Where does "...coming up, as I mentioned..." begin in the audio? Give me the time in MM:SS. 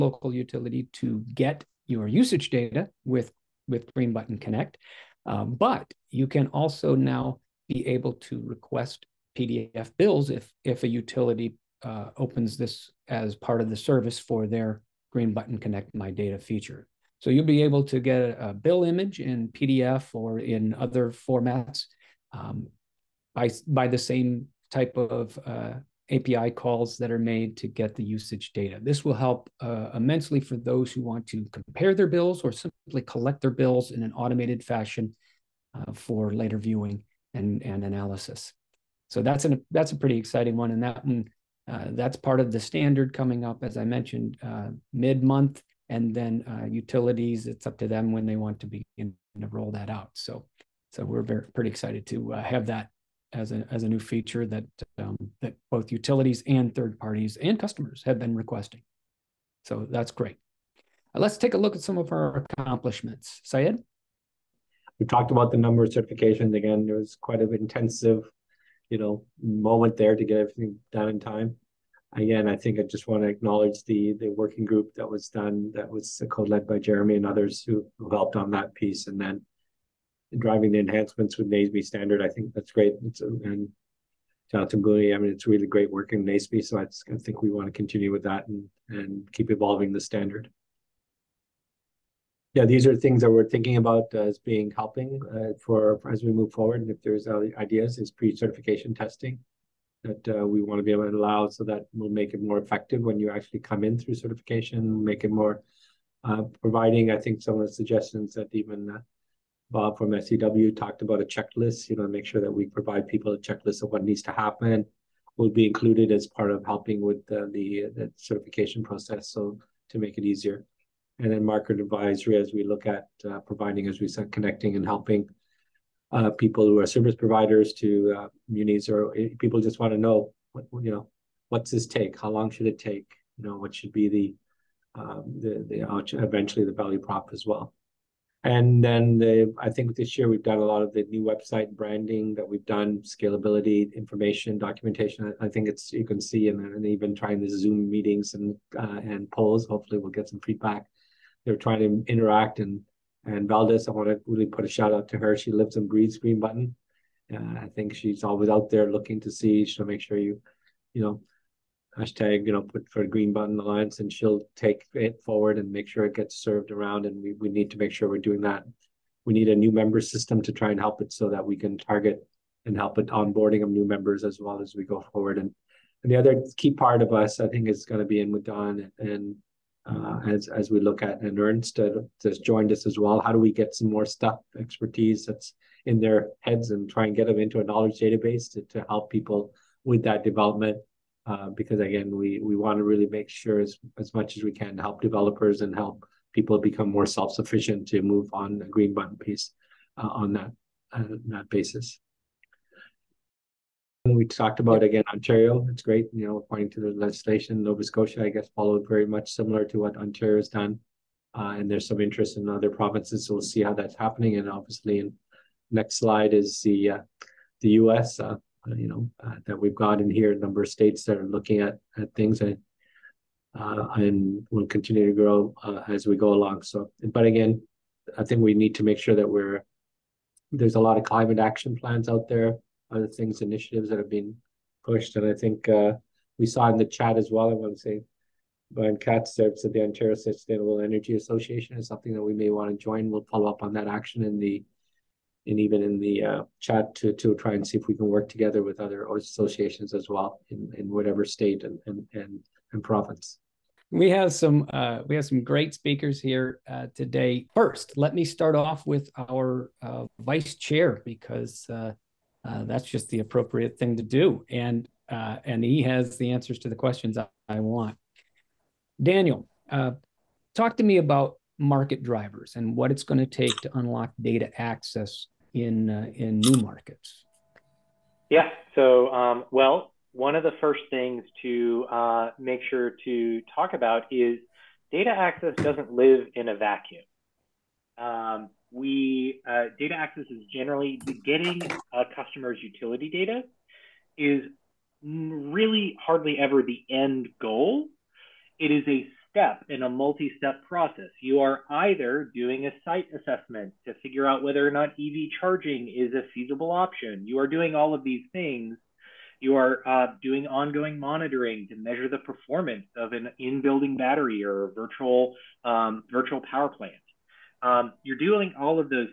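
00:43.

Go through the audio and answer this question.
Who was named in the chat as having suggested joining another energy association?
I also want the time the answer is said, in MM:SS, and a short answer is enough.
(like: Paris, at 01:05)
Brian Katz, at 03:58.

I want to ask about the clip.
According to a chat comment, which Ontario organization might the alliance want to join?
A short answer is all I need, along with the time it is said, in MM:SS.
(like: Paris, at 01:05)
Ontario Sustainable Energy Association, at 03:59.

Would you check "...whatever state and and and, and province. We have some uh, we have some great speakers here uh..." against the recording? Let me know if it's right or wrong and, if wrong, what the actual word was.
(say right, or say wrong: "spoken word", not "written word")
right.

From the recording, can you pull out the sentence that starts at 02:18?
And then the, I think this year we've got a lot of the new website branding that we've done, scalability, information, documentation.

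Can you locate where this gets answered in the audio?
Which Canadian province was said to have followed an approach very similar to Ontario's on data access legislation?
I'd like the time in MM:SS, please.
03:27.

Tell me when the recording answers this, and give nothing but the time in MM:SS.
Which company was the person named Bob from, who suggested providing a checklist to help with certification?
01:50.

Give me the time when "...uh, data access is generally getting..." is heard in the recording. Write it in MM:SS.
04:49.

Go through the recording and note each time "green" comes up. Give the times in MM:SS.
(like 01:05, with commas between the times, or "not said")
00:03, 00:15, 02:36, 02:43, 03:18.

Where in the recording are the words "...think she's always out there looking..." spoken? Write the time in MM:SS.
02:37.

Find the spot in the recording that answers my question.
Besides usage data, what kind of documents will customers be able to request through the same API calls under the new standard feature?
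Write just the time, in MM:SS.
00:09.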